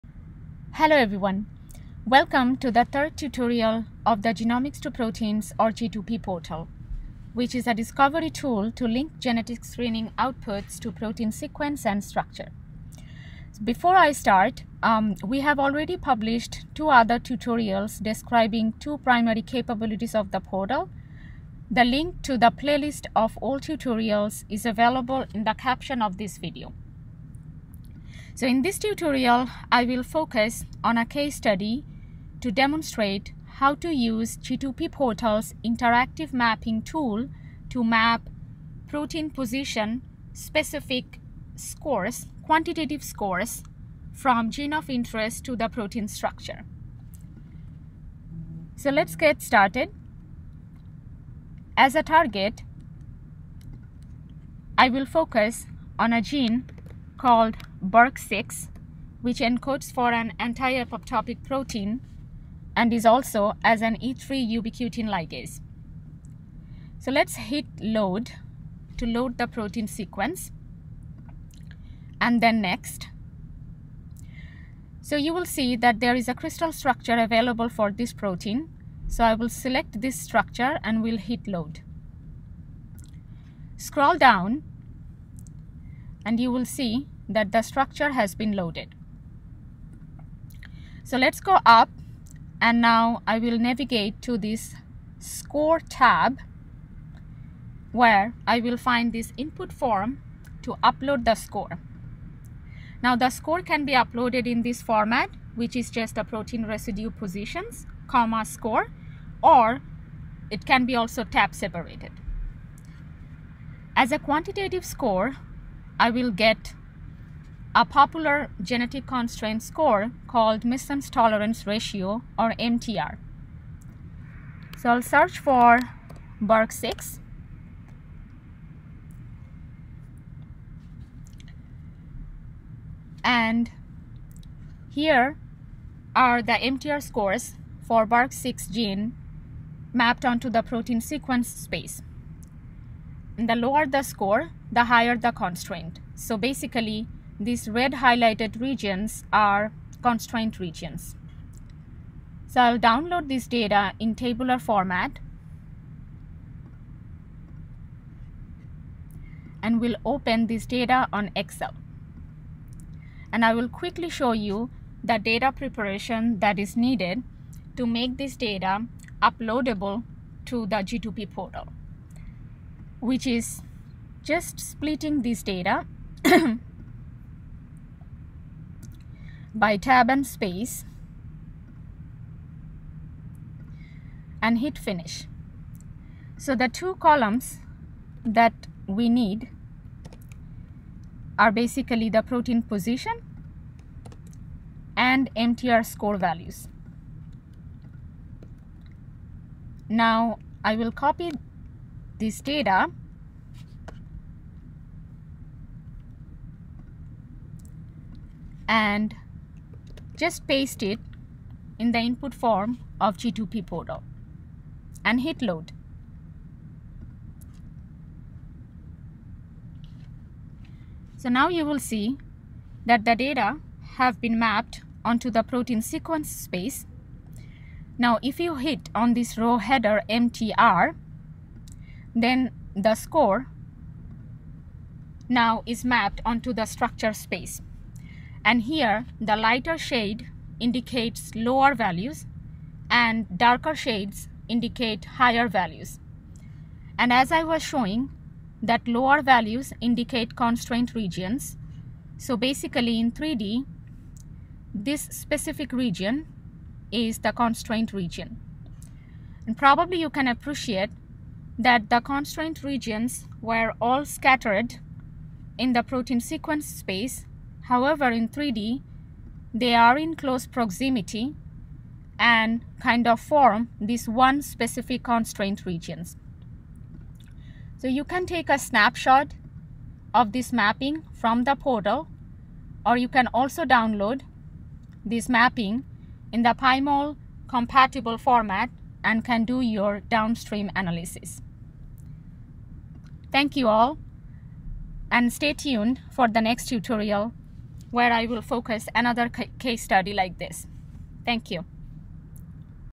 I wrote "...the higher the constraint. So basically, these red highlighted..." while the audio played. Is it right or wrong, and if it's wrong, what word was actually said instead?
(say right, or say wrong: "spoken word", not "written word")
right.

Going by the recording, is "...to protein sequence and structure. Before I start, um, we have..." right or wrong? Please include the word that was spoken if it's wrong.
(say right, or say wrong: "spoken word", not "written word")
right.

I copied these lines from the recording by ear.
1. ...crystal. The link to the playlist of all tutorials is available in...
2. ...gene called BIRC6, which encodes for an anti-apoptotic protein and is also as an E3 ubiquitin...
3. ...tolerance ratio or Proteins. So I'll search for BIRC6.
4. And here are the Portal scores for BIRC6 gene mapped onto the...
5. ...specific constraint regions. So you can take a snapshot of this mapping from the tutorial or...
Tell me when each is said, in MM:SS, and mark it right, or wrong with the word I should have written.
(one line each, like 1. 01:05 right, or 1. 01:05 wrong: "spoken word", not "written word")
1. 00:20 wrong: "portal", not "crystal"
2. 00:56 right
3. 02:01 wrong: "MTR", not "Proteins"
4. 02:13 wrong: "MTR", not "Portal"
5. 04:34 wrong: "portal", not "tutorial".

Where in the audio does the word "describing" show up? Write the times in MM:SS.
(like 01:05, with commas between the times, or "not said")
00:18.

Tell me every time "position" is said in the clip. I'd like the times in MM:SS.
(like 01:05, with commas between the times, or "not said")
00:39, 01:47, 03:12.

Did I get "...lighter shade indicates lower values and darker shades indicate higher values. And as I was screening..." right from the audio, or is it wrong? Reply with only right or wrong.
wrong.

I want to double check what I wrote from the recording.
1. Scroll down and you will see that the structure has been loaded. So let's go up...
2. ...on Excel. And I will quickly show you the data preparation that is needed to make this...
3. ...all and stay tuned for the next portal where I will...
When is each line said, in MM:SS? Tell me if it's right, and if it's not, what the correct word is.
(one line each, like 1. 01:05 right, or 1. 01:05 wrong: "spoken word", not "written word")
1. 01:23 right
2. 02:41 right
3. 04:53 wrong: "tutorial", not "portal".